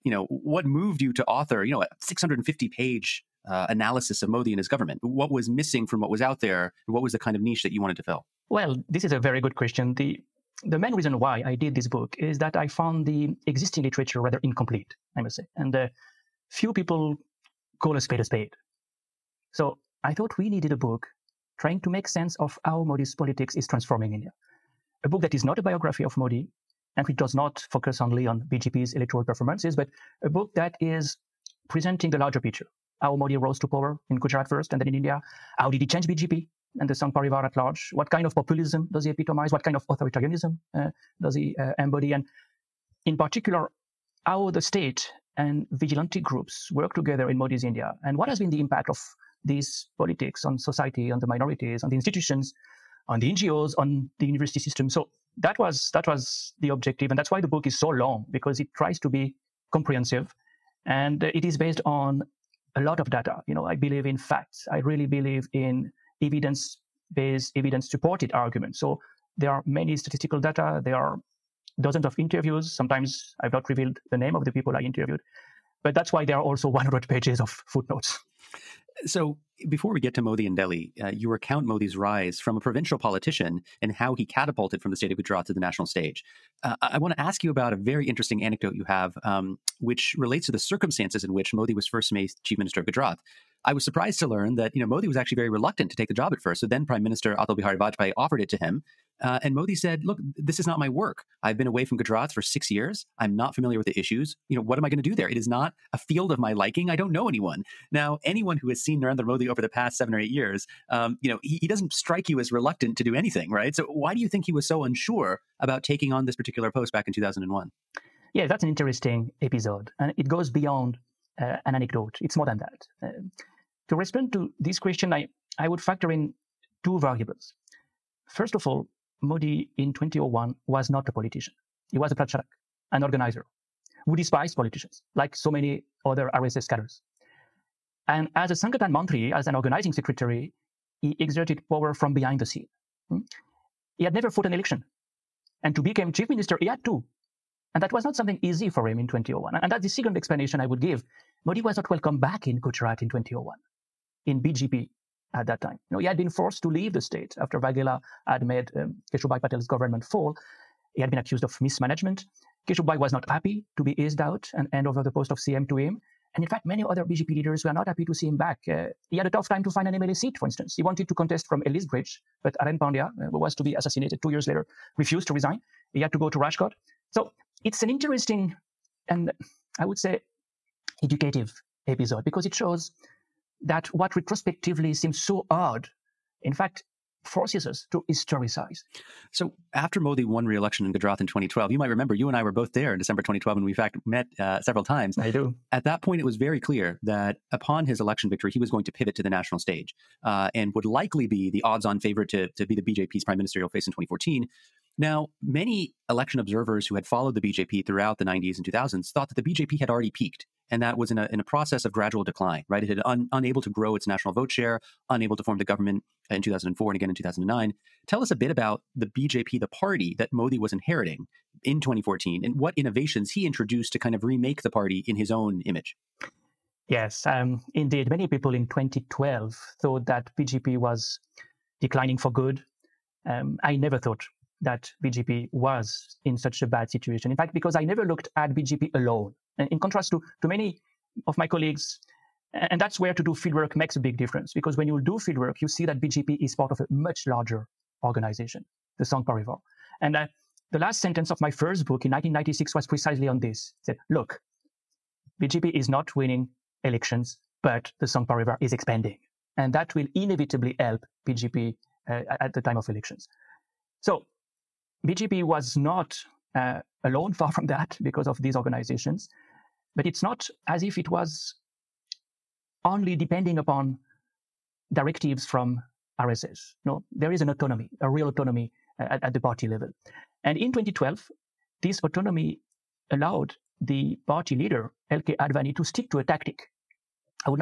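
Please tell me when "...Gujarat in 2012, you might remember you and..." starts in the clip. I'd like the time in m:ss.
3:10.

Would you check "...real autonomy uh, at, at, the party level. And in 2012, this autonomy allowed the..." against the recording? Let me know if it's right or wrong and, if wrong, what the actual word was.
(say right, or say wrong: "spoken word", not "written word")
right.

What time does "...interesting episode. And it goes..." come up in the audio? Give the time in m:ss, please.
1:58.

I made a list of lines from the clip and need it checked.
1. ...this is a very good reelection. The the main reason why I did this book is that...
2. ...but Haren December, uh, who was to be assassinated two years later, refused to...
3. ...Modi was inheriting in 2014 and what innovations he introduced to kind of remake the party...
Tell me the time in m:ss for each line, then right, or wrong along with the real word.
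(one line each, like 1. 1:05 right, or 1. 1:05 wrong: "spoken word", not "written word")
1. 0:08 wrong: "question", not "reelection"
2. 2:52 wrong: "Pandya", not "December"
3. 3:40 right.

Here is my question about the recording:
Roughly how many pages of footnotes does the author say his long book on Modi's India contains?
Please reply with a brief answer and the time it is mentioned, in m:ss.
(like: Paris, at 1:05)
100, at 1:16.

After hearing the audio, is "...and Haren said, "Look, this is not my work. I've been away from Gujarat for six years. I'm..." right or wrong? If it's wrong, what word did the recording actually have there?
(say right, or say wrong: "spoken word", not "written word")
wrong: "Modi", not "Haren".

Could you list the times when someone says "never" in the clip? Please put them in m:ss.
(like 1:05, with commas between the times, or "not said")
2:24, 3:53, 3:57.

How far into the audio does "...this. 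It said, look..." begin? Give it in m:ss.
4:13.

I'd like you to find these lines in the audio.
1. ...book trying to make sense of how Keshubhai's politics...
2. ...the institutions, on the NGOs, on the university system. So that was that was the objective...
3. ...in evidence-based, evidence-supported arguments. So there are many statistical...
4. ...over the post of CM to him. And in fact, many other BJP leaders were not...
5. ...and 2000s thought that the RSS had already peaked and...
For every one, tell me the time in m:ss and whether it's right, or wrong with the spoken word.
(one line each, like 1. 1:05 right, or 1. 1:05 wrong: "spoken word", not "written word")
1. 0:20 wrong: "Modi", not "Keshubhai"
2. 0:51 right
3. 1:05 right
4. 2:44 right
5. 3:28 wrong: "BJP", not "RSS".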